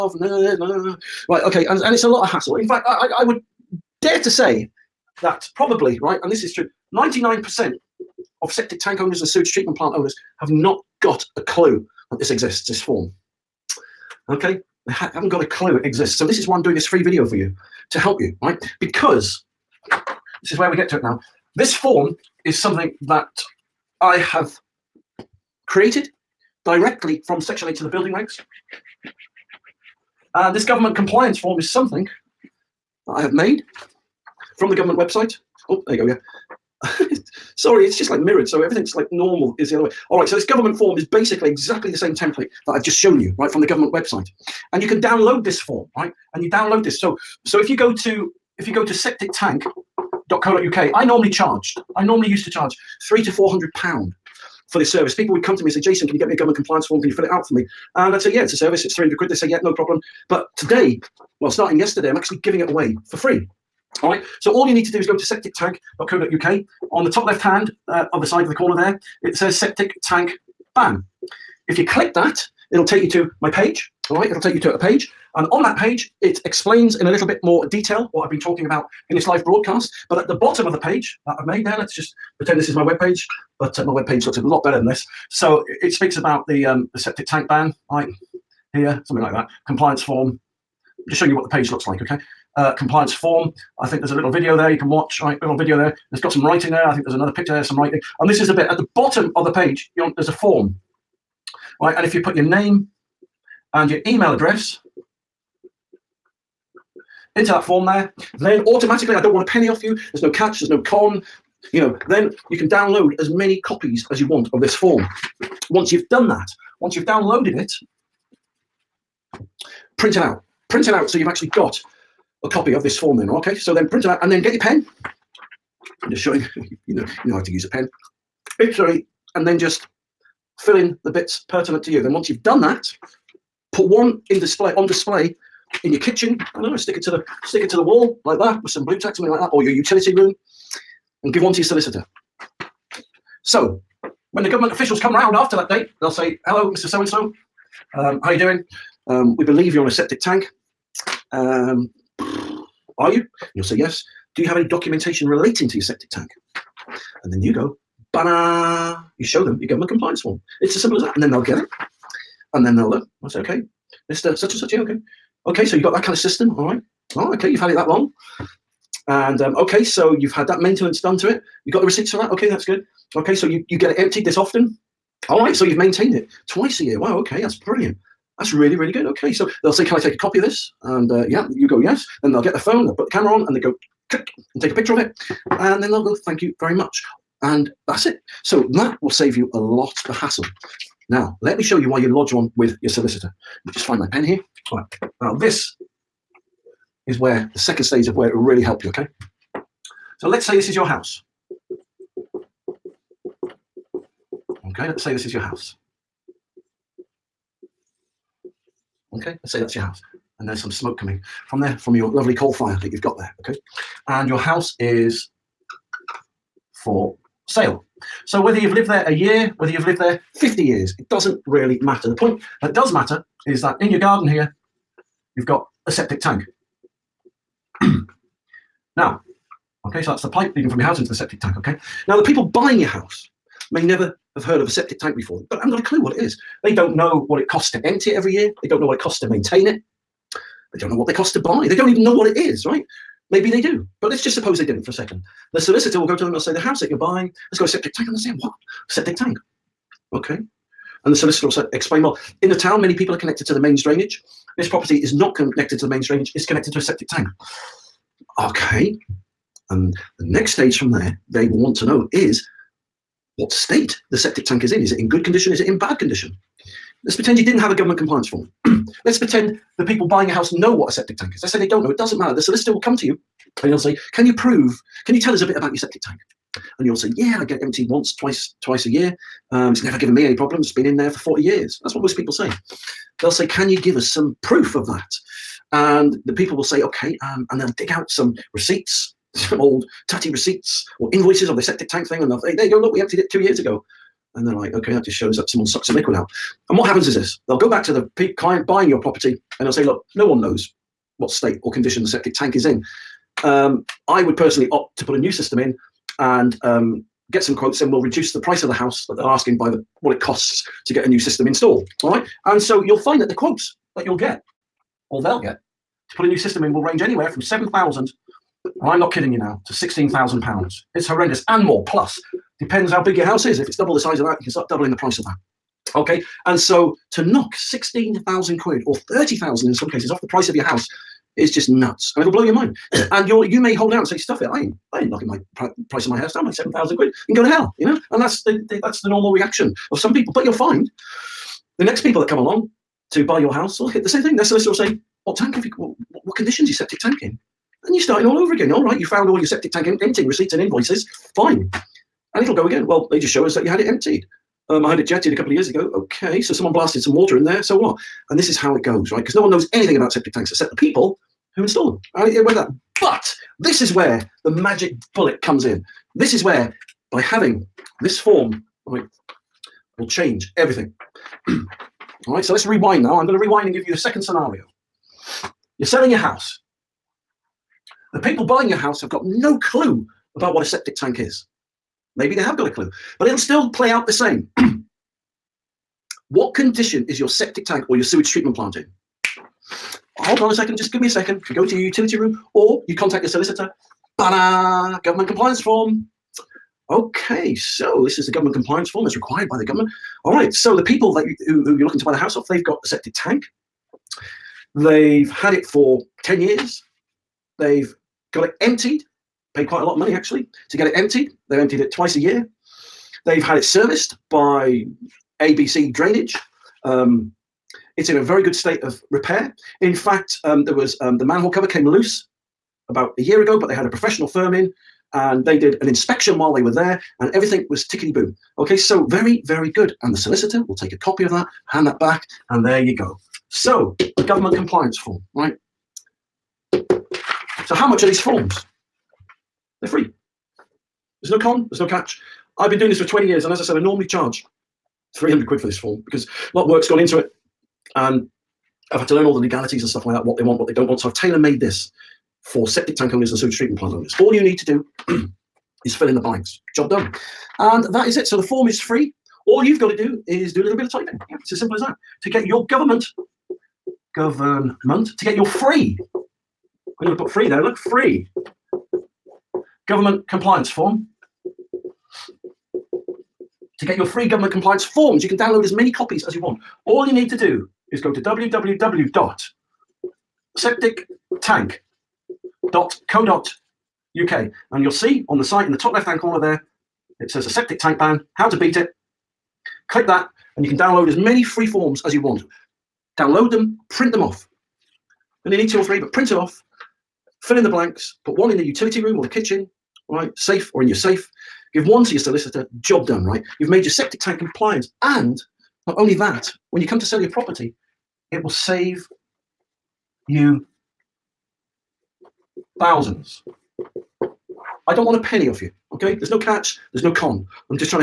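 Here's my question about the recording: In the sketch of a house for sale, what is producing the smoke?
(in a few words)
coal fire.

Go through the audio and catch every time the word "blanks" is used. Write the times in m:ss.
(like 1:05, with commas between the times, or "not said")
7:36, 8:17.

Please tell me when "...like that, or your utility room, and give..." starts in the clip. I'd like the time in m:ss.
2:19.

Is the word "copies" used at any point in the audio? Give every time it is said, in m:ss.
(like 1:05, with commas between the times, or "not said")
1:53, 7:55.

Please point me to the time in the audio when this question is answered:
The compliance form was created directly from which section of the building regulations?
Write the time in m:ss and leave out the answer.
0:27.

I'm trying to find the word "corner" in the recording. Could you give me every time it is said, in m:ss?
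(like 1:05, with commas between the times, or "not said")
1:08, 8:06.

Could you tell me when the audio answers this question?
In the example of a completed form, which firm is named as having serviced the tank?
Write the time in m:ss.
6:55.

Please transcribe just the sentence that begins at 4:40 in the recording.
It's been in there for 40 years.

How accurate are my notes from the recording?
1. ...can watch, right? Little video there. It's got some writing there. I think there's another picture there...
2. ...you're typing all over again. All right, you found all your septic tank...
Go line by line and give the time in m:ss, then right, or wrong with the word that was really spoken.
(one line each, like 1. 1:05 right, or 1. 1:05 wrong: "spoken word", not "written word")
1. 1:34 right
2. 5:47 wrong: "starting", not "typing".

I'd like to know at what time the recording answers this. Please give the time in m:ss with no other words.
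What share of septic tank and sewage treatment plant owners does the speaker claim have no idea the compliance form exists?
0:06.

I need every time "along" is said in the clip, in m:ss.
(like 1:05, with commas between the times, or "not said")
5:42.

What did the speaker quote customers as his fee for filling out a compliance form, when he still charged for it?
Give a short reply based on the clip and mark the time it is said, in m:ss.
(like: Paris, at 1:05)
300 quid, at 0:58.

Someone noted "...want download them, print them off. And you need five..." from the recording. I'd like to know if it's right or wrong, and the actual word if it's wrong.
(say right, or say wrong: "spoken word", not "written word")
wrong: "two", not "five".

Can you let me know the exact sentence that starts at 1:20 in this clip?
But at the bottom of the page that I've made there, let's just pretend this is my web page.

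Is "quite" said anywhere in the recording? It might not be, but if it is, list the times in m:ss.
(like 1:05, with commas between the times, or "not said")
6:49.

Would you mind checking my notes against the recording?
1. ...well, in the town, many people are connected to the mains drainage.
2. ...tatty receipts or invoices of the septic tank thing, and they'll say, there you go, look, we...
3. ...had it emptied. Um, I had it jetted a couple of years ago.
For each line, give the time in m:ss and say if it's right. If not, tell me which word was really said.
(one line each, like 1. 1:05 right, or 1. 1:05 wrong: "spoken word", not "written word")
1. 4:12 right
2. 4:50 right
3. 5:53 right.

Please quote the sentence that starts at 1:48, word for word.
Then automatically, I don't want a penny off you.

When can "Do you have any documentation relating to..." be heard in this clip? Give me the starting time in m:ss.
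2:34.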